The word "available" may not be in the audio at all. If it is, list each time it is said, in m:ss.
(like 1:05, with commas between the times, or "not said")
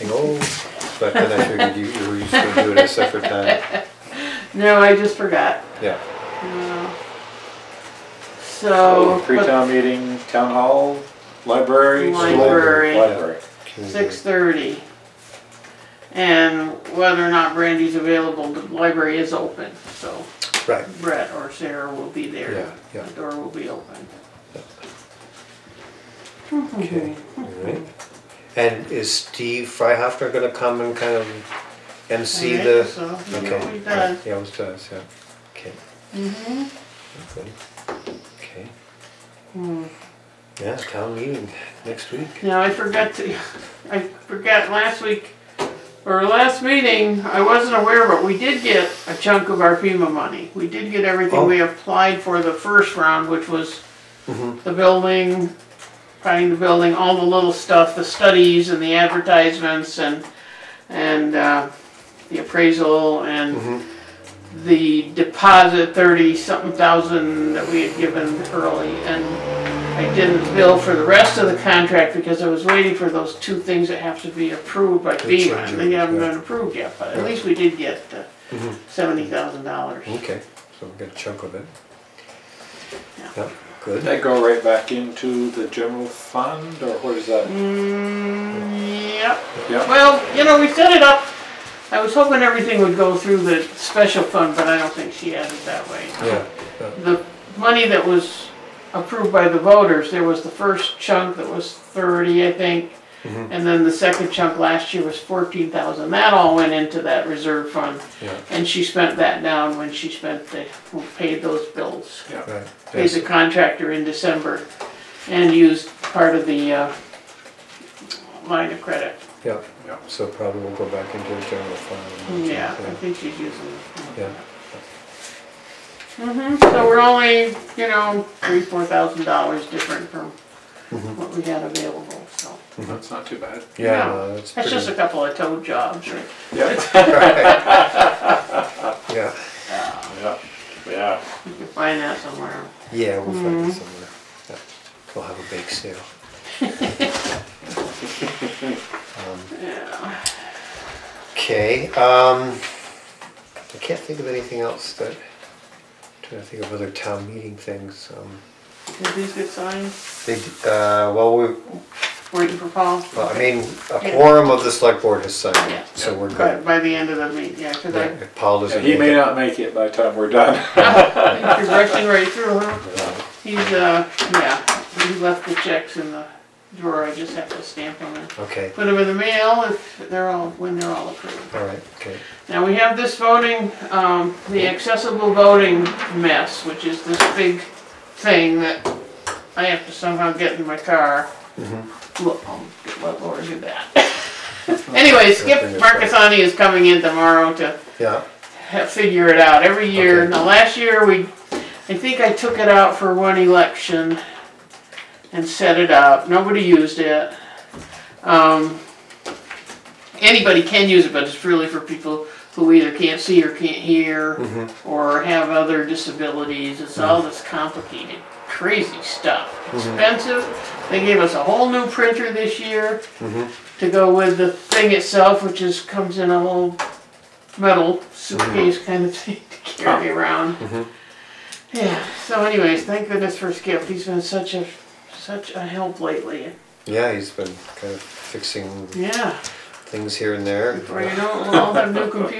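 0:17, 2:11.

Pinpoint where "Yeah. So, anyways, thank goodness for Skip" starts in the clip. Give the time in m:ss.
3:51.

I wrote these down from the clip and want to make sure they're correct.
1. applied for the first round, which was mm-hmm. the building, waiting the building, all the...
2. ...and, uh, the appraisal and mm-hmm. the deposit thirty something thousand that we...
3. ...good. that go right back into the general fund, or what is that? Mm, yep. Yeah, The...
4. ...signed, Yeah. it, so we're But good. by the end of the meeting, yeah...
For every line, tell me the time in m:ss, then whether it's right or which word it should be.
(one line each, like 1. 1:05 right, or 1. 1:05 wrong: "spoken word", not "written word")
1. 0:51 wrong: "finding", not "waiting"
2. 1:00 right
3. 1:23 wrong: "Well", not "The"
4. 2:45 right.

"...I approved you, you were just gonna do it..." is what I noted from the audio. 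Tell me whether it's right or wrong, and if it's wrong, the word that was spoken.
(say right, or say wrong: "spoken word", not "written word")
wrong: "figured", not "approved".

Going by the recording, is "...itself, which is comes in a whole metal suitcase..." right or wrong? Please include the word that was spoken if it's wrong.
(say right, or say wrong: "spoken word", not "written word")
right.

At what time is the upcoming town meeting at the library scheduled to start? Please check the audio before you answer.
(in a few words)
6:30.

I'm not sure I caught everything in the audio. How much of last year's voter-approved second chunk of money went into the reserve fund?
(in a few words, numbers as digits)
14,000.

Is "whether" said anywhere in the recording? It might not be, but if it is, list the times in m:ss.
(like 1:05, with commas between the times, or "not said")
0:16.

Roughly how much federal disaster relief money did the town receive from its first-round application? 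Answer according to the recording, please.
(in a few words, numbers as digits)
$70,000.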